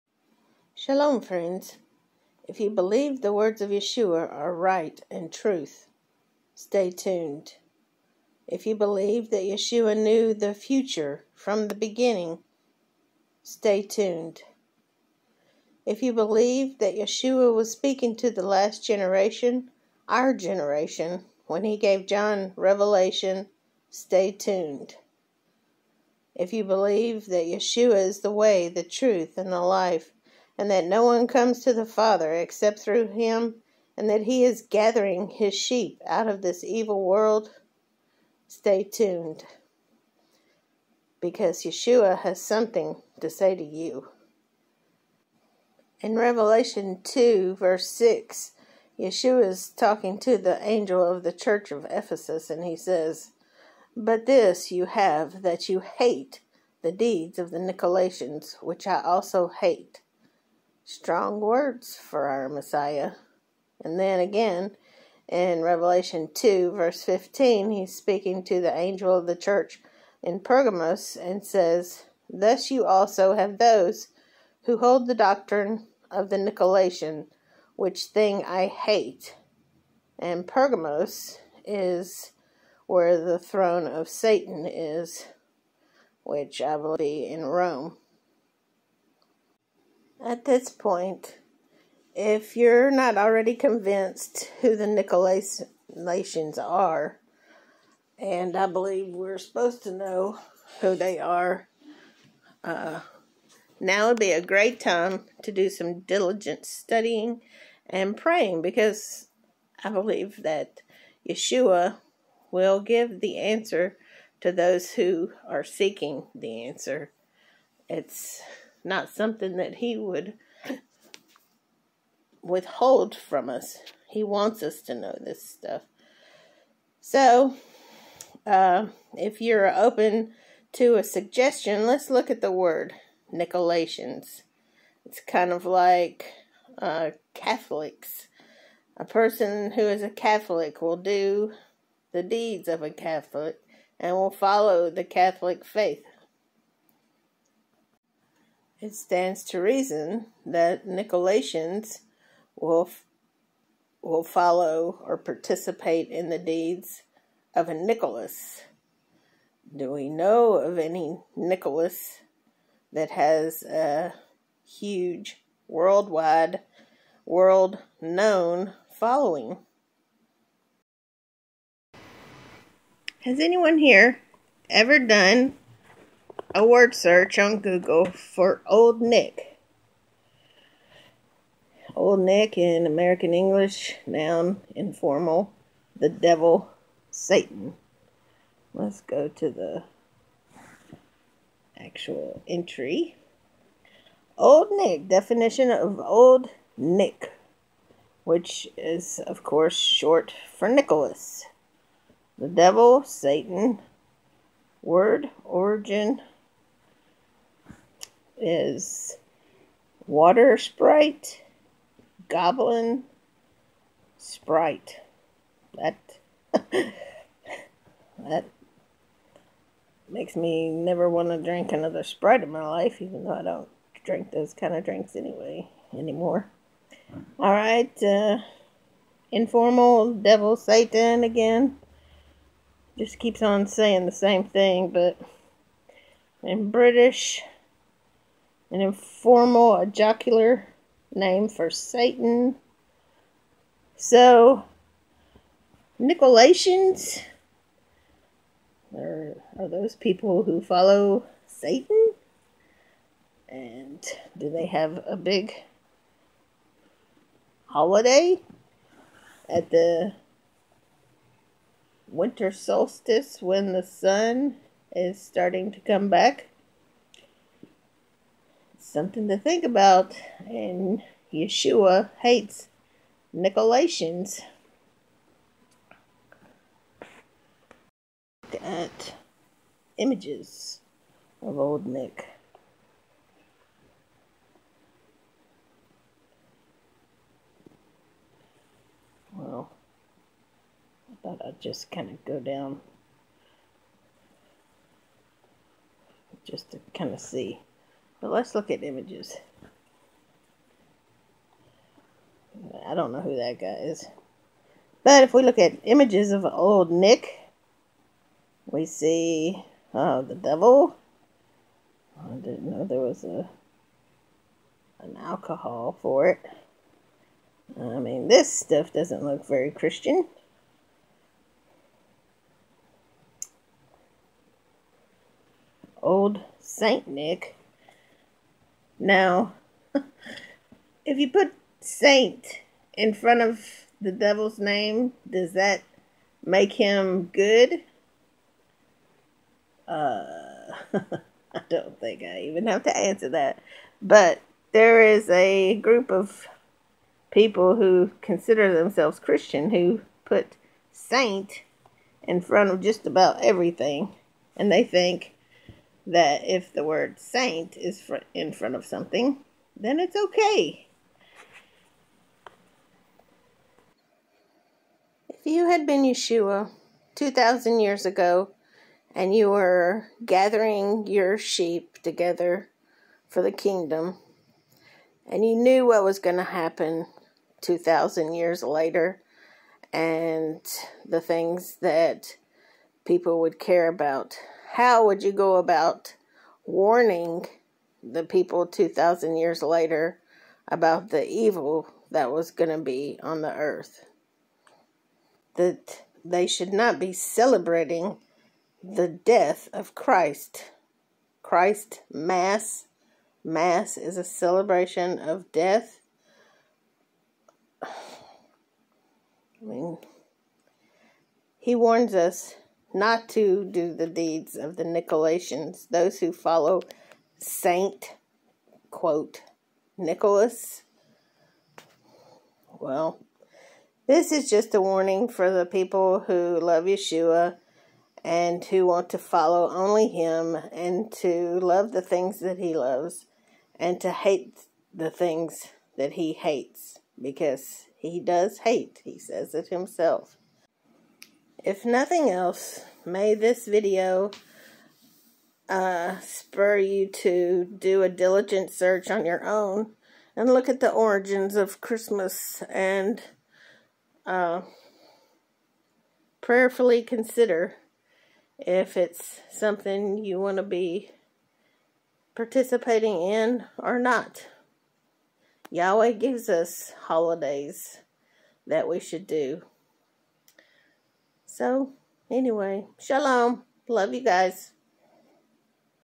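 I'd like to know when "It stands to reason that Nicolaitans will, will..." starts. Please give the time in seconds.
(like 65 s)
148 s.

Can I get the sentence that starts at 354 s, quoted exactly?
And they think that if the word saint is fr in front of something, then it's okay.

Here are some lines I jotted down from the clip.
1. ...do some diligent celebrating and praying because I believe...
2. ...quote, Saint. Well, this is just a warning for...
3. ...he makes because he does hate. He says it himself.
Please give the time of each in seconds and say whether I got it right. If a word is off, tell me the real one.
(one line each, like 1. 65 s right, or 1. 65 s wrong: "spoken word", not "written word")
1. 105 s wrong: "studying", not "celebrating"
2. 418 s wrong: "Nicholas", not "Saint"
3. 436 s wrong: "hates", not "makes".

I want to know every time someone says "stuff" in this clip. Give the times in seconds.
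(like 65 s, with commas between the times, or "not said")
125 s, 318 s.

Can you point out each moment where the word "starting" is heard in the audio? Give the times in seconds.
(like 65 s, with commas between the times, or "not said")
265 s.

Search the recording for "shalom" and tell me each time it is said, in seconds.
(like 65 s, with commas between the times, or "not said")
0 s, 472 s.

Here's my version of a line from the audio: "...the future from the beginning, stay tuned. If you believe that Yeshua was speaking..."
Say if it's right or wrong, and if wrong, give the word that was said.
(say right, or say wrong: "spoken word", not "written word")
right.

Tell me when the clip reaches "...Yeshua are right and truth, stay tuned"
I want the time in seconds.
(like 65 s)
3 s.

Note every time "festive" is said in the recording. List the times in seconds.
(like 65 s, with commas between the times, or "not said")
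not said.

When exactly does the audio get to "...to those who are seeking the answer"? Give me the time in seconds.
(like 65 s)
114 s.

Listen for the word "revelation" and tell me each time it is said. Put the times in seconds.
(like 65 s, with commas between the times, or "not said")
22 s, 46 s, 65 s.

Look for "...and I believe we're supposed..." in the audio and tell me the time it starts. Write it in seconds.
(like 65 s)
98 s.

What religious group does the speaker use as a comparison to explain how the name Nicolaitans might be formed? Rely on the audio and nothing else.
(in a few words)
Catholics.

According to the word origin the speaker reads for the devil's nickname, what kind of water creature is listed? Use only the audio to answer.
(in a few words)
Water Sprite.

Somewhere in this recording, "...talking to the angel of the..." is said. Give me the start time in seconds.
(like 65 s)
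49 s.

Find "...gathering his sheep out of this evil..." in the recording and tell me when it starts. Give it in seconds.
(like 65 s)
34 s.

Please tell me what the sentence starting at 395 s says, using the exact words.
That they should not be celebrating the death of Christ.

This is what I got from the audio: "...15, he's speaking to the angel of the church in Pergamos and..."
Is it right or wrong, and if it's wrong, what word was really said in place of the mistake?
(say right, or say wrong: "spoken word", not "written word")
right.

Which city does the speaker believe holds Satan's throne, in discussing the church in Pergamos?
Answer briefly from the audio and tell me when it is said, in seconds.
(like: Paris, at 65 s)
Rome, at 87 s.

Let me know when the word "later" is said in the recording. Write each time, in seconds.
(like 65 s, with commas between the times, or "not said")
378 s, 389 s.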